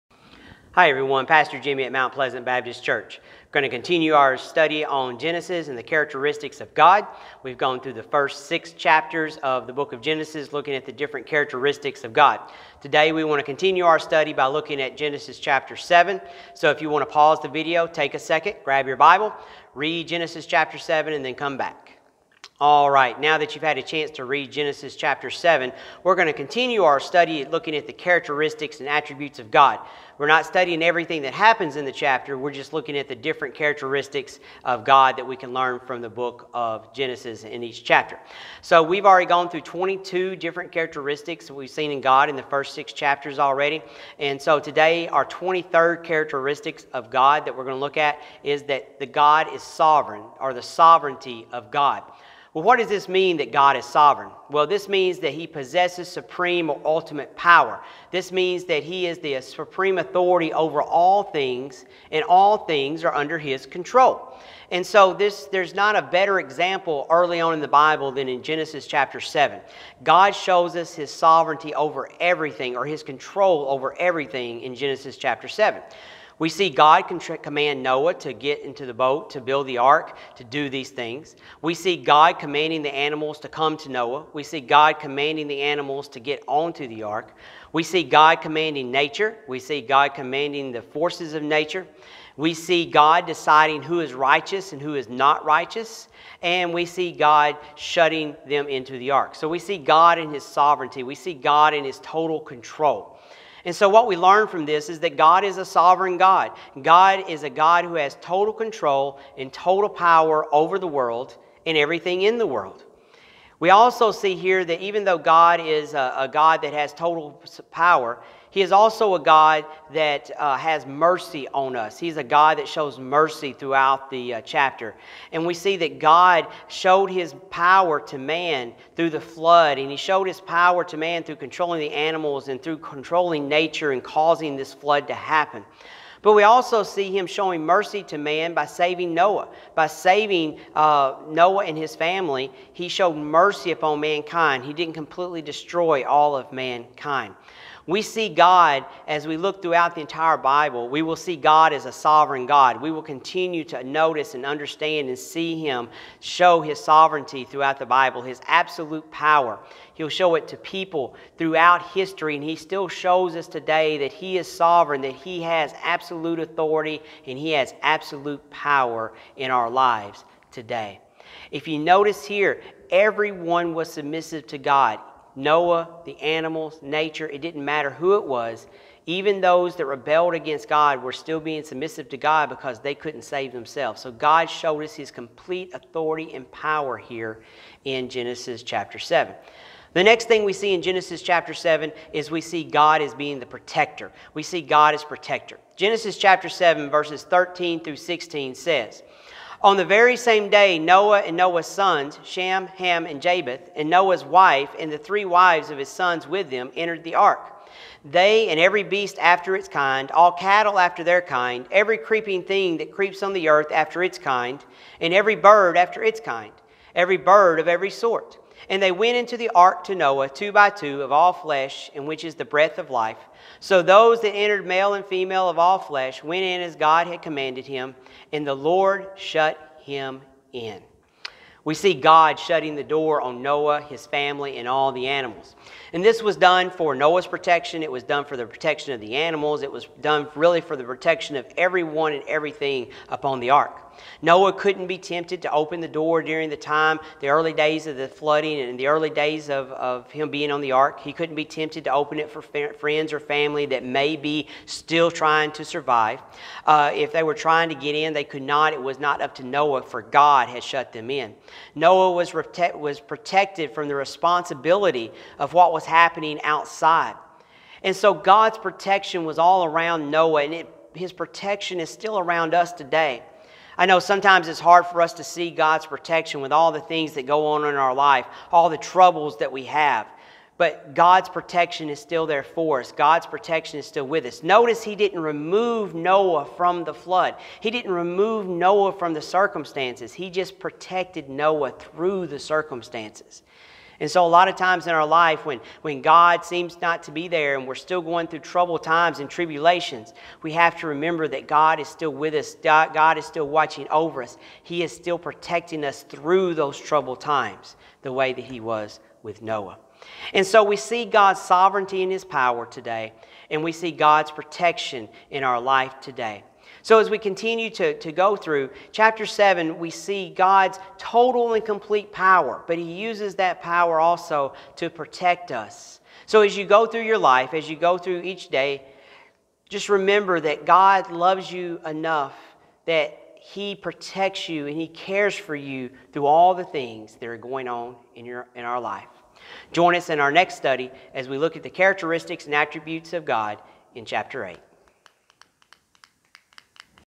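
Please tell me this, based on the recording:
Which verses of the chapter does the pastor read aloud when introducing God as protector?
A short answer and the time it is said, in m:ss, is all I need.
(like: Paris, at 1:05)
13 through 16, at 3:16.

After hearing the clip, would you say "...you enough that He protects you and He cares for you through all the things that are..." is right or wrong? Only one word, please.
right.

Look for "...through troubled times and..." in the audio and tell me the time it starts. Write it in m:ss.
4:58.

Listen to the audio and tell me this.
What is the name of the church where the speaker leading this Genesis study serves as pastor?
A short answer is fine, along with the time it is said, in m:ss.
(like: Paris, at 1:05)
Mount Pleasant Baptist Church, at 0:01.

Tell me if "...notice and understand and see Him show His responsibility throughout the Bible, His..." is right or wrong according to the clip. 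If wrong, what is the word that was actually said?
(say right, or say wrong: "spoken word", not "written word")
wrong: "sovereignty", not "responsibility".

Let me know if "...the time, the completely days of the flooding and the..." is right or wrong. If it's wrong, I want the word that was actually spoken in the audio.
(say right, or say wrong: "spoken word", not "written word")
wrong: "early", not "completely".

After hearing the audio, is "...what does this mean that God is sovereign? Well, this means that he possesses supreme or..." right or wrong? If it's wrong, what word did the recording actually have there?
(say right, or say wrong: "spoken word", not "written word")
right.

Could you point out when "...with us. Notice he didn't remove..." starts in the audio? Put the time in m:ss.
4:44.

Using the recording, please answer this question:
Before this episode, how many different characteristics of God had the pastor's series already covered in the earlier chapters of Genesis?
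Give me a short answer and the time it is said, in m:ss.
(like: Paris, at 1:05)
22, at 0:39.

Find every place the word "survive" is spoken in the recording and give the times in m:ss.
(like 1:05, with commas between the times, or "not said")
4:15.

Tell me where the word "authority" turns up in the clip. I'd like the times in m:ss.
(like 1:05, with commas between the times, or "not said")
0:59, 2:46, 3:05.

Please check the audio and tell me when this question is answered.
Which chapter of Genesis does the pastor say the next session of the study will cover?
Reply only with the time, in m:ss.
5:44.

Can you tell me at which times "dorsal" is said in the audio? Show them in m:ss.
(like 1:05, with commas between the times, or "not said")
not said.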